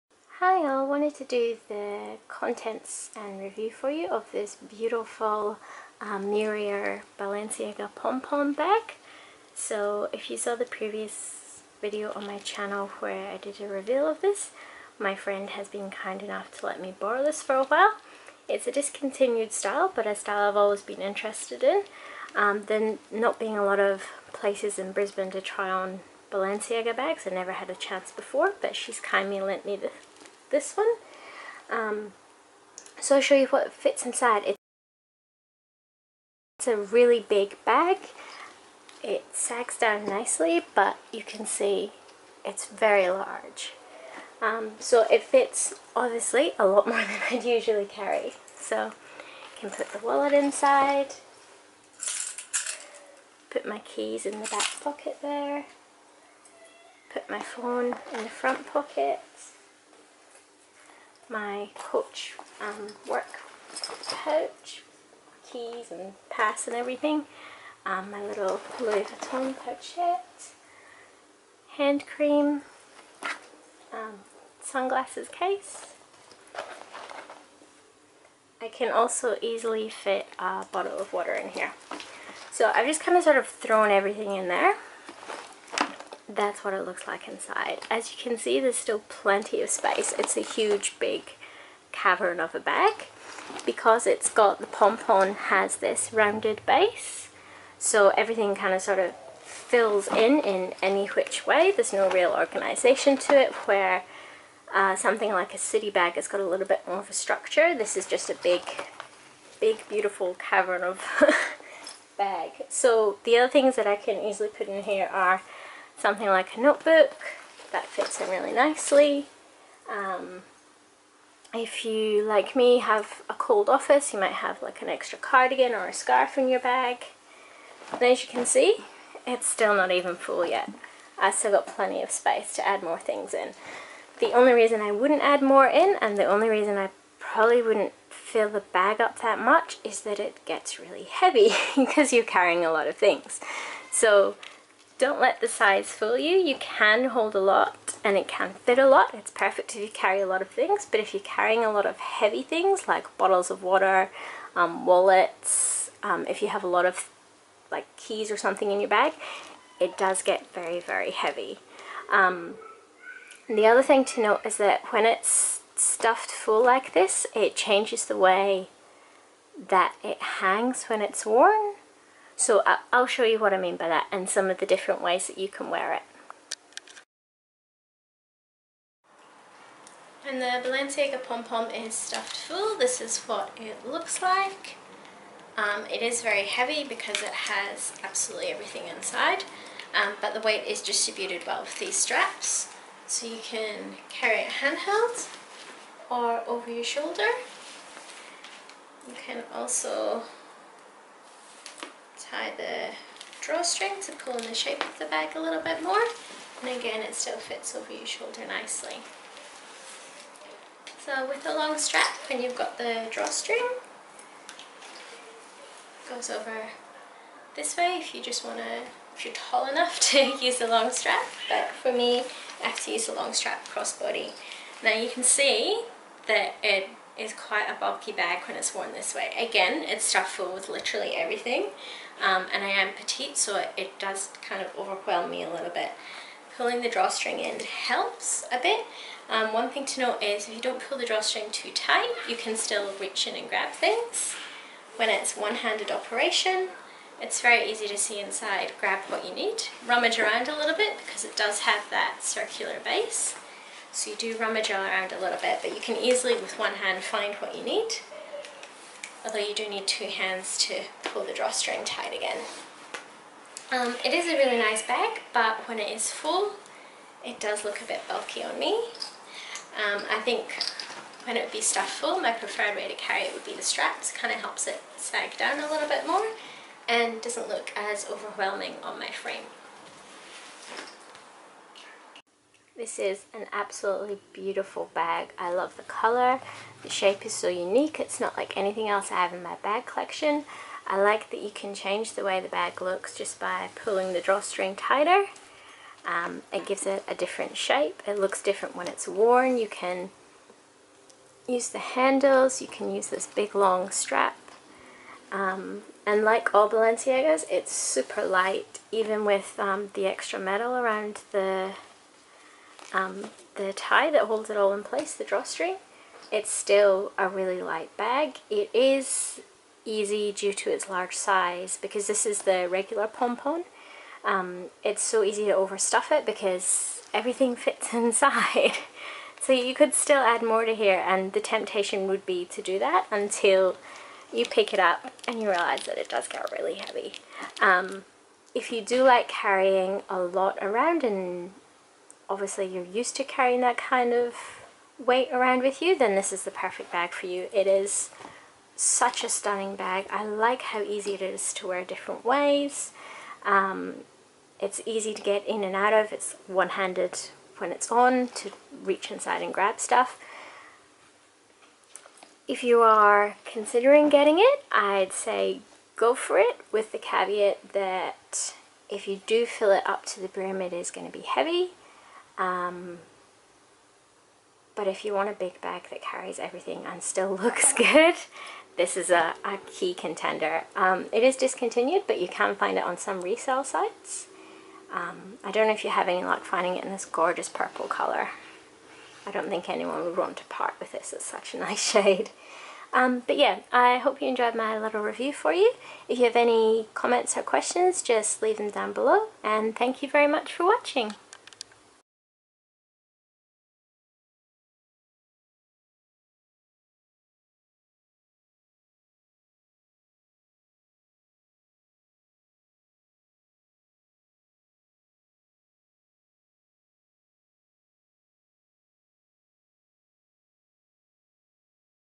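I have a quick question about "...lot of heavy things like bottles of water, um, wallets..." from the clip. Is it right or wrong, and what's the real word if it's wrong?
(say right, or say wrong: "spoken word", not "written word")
right.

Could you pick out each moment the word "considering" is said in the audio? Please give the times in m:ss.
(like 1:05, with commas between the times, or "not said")
6:03.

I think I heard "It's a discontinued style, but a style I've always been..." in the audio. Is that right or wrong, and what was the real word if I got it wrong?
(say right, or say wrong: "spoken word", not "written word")
right.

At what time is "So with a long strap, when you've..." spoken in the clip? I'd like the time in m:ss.
3:31.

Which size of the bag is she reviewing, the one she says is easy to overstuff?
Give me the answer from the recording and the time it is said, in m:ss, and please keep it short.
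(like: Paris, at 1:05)
Regular, at 5:22.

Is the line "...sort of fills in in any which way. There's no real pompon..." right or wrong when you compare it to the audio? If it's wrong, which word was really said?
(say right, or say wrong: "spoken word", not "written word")
wrong: "organization", not "pompon".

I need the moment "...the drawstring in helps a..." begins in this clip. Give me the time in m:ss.
3:56.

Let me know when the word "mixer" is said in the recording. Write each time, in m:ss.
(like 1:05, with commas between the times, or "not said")
not said.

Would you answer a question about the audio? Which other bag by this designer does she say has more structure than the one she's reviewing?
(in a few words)
City bag.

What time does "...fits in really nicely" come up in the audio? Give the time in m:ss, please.
1:57.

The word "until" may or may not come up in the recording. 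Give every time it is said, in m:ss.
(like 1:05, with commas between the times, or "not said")
5:33.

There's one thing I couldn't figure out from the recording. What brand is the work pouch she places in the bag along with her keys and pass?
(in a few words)
Coach.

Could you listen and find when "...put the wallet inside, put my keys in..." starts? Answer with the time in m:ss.
0:49.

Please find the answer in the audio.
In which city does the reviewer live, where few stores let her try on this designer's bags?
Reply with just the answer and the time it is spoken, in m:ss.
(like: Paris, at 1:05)
Brisbane, at 0:24.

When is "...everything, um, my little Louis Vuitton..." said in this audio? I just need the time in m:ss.
1:06.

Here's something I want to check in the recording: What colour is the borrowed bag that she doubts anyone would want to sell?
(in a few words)
Purple.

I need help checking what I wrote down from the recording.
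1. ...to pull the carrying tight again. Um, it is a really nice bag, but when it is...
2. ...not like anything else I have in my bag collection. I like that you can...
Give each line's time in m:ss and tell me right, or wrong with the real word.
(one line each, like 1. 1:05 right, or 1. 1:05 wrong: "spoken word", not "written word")
1. 4:20 wrong: "drawstring", not "carrying"
2. 4:48 right.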